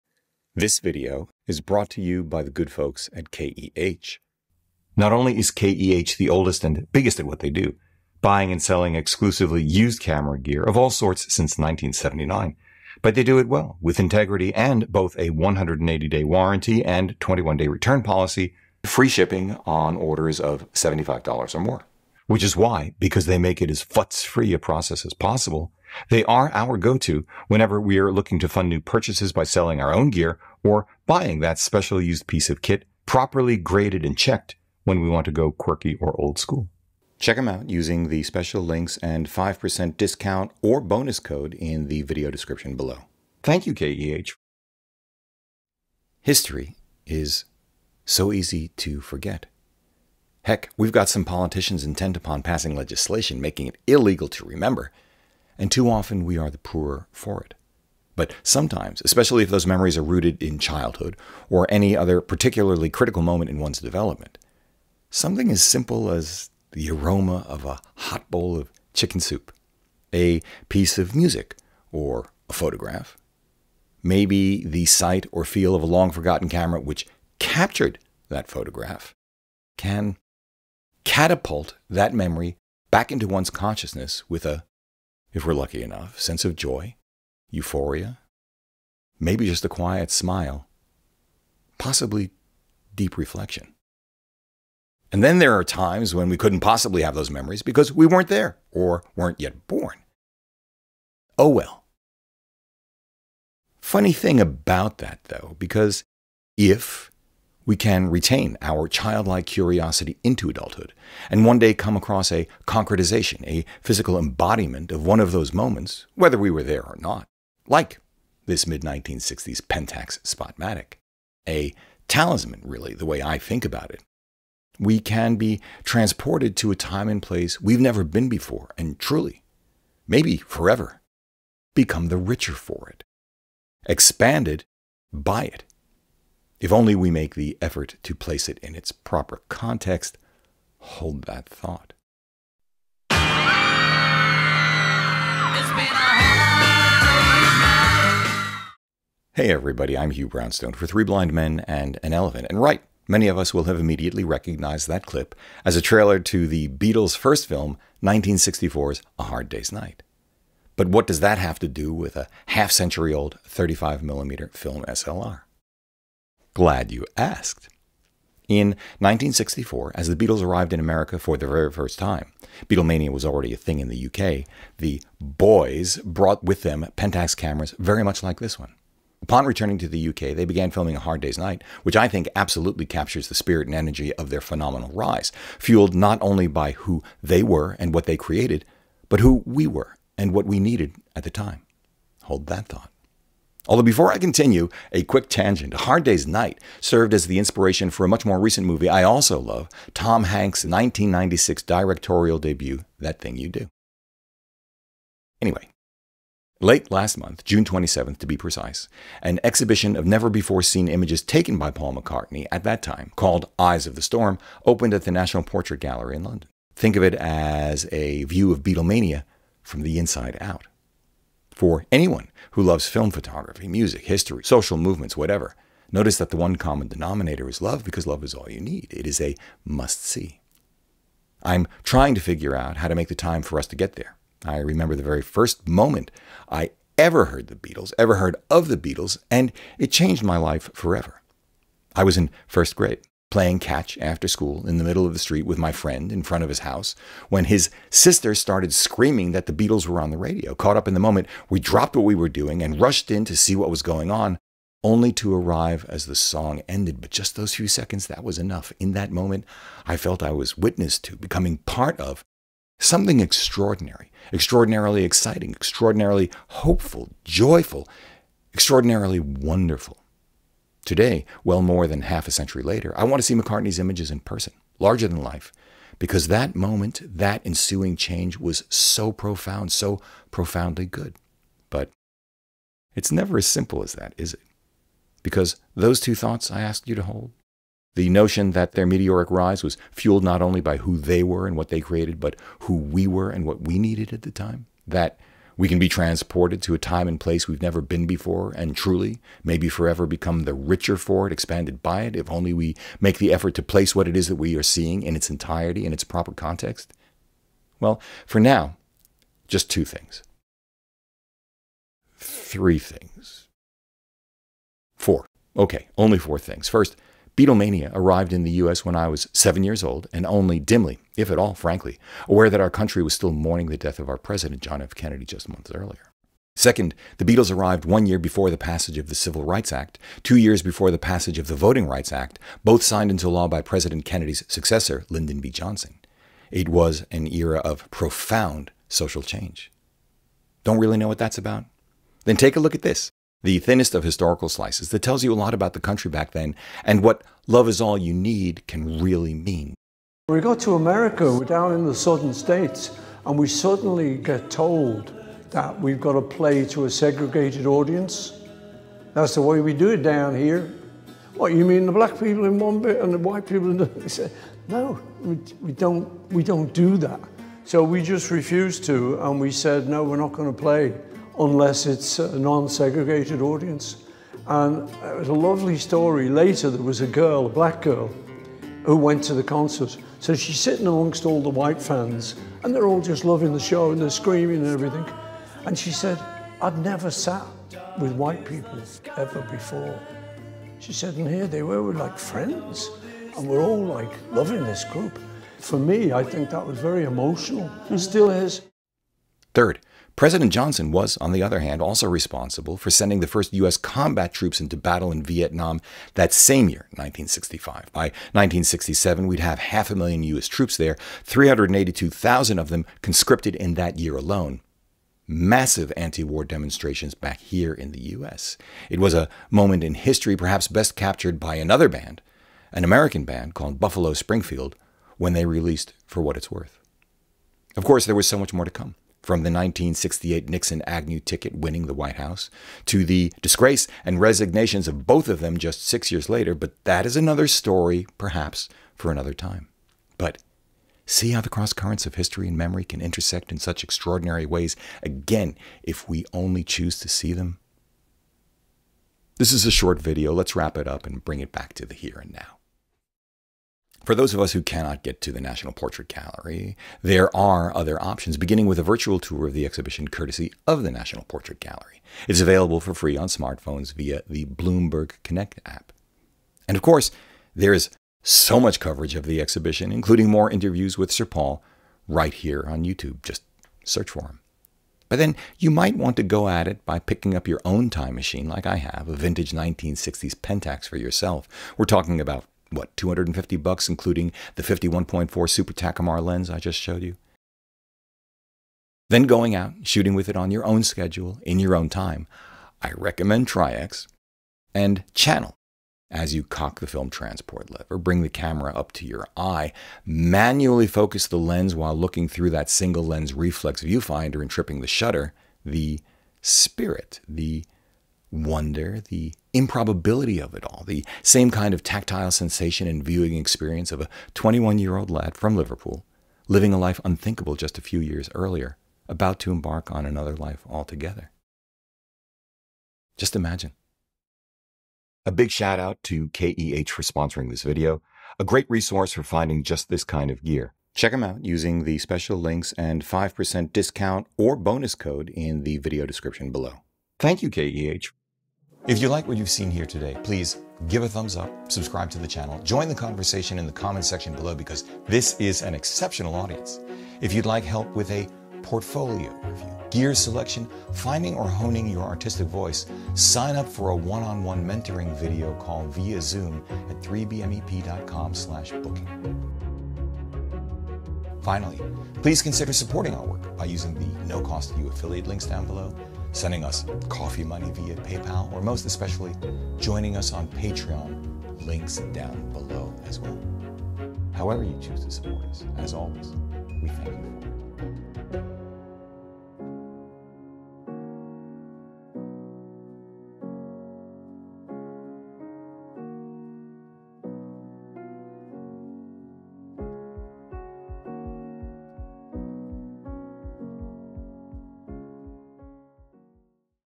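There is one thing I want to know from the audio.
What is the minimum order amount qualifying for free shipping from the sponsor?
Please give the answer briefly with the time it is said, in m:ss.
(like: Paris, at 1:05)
$75, at 0:20.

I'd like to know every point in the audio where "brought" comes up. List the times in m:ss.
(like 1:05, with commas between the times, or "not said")
0:01, 2:56.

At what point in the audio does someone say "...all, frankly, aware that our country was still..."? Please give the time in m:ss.
5:21.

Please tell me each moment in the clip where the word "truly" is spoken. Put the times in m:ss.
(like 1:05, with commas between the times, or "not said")
2:08, 4:58.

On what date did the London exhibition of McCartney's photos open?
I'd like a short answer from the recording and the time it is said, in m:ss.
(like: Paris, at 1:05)
June 27th, at 3:27.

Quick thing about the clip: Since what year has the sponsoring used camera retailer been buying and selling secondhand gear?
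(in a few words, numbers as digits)
1979.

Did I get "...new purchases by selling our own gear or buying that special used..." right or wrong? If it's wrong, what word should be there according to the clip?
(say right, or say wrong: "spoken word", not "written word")
right.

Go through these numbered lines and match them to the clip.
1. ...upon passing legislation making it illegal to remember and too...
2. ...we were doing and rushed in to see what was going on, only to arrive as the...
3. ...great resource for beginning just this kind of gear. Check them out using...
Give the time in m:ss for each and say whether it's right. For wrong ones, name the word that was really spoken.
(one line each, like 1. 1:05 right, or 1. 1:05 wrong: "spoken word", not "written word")
1. 0:52 right
2. 4:12 right
3. 8:48 wrong: "finding", not "beginning".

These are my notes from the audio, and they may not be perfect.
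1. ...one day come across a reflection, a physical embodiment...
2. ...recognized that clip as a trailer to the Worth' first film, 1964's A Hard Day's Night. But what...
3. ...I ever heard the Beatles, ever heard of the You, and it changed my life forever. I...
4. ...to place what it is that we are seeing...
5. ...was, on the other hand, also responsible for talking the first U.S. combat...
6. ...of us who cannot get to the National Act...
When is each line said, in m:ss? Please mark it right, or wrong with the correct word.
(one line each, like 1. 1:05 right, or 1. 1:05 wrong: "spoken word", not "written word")
1. 1:51 wrong: "concretization", not "reflection"
2. 2:34 wrong: "Beatles", not "Worth"
3. 3:56 wrong: "Beatles", not "You"
4. 5:03 right
5. 6:40 wrong: "sending", not "talking"
6. 7:34 wrong: "Portrait", not "Act".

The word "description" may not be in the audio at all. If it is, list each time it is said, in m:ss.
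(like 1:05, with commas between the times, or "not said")
0:42, 8:56.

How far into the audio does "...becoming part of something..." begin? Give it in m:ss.
4:21.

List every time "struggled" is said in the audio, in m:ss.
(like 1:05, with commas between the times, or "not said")
not said.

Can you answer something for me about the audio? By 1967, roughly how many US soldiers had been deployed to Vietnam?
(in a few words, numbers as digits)
half a million.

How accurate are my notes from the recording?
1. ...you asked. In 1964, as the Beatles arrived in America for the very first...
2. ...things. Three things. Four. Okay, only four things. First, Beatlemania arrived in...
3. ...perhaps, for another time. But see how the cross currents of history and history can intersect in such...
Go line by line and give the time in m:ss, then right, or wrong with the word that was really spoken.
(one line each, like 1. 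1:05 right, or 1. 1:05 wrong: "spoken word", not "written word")
1. 2:46 right
2. 5:09 right
3. 7:18 wrong: "memory", not "history".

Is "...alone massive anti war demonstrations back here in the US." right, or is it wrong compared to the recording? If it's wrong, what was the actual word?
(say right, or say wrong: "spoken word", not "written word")
right.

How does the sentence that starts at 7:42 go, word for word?
It's available for free on smartphones via the Bloomberg Connect app.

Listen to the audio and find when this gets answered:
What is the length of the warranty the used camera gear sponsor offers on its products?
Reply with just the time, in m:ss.
0:15.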